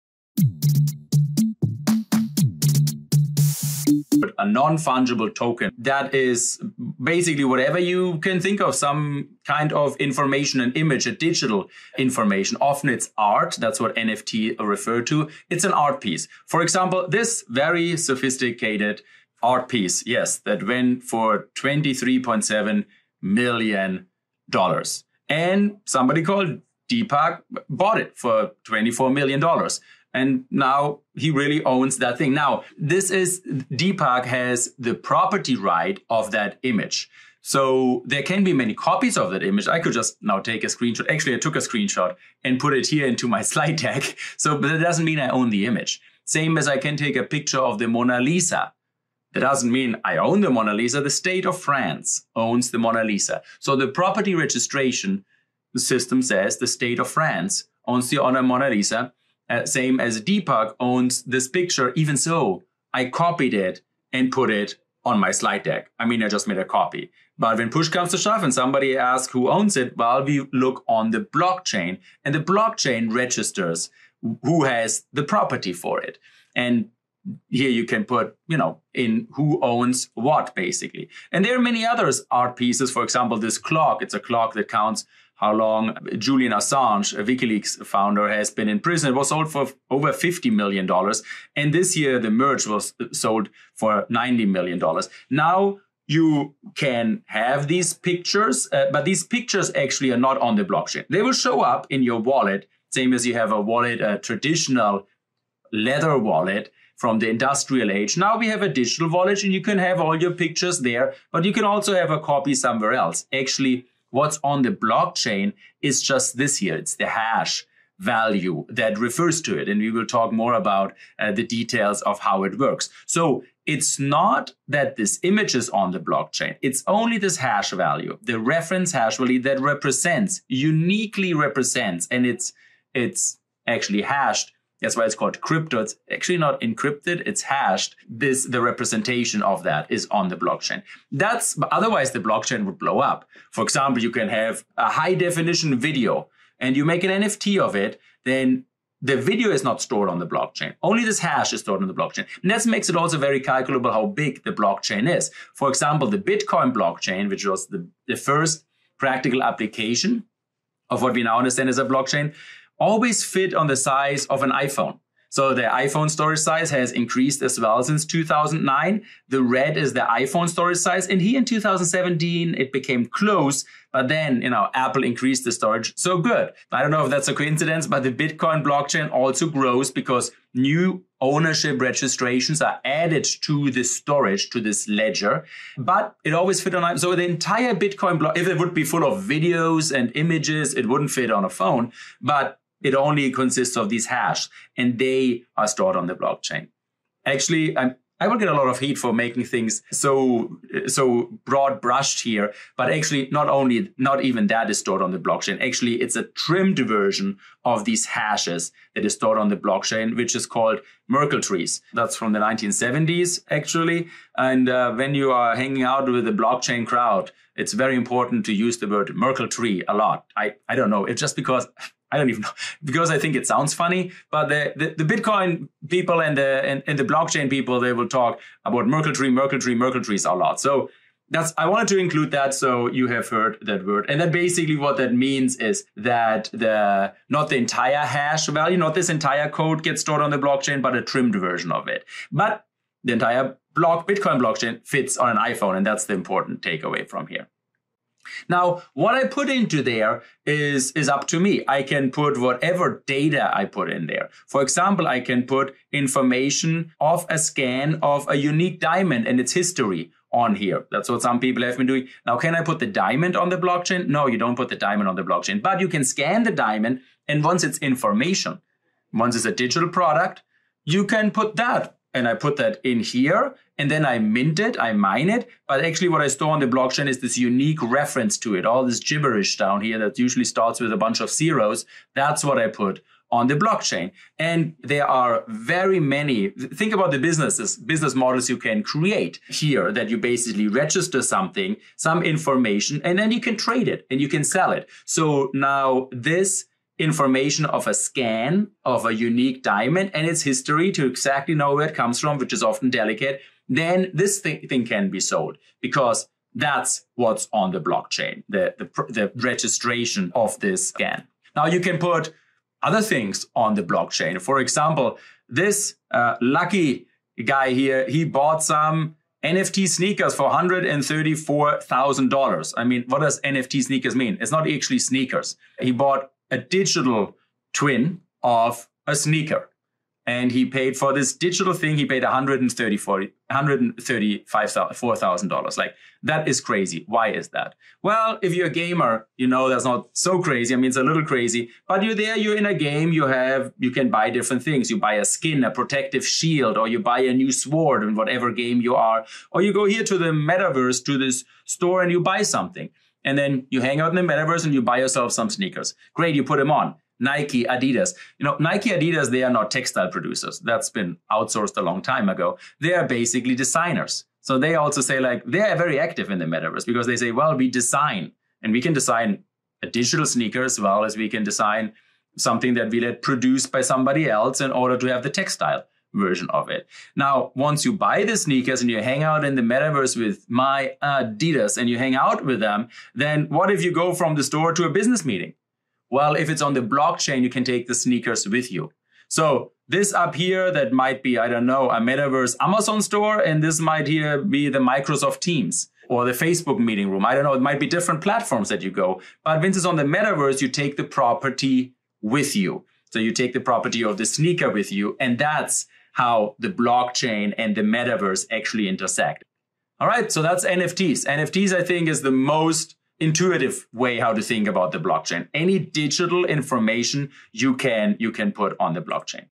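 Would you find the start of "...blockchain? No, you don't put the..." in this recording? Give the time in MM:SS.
04:23.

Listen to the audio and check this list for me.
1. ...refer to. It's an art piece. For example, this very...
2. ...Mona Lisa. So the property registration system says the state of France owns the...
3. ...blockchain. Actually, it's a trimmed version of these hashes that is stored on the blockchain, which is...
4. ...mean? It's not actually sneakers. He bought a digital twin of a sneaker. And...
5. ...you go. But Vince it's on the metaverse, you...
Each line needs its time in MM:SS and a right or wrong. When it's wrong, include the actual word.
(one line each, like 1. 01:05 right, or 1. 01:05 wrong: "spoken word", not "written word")
1. 00:14 right
2. 00:52 right
3. 03:25 right
4. 05:24 right
5. 06:38 right.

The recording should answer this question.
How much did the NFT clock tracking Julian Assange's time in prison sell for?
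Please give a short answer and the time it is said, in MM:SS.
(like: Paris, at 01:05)
Over $50 million, at 01:29.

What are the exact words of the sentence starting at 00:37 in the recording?
So there can be many copies of that image.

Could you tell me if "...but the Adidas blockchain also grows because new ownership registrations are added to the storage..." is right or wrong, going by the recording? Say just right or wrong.
wrong.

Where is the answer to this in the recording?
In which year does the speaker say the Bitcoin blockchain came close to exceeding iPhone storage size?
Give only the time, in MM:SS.
02:51.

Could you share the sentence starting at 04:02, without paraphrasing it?
But the entire block Bitcoin blockchain fits on an iPhone, and that's the important takeaway from here.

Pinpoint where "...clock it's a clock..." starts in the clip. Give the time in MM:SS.
01:23.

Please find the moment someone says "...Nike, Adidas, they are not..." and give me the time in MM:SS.
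05:58.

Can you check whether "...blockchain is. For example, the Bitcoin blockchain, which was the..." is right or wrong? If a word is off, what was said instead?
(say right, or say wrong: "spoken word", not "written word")
right.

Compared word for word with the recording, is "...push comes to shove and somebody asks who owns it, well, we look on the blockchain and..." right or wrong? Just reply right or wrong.
right.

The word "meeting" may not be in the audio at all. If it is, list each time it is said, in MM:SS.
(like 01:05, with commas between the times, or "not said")
06:25, 06:36.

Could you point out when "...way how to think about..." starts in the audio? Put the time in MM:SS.
06:53.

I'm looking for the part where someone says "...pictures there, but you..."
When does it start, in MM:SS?
01:50.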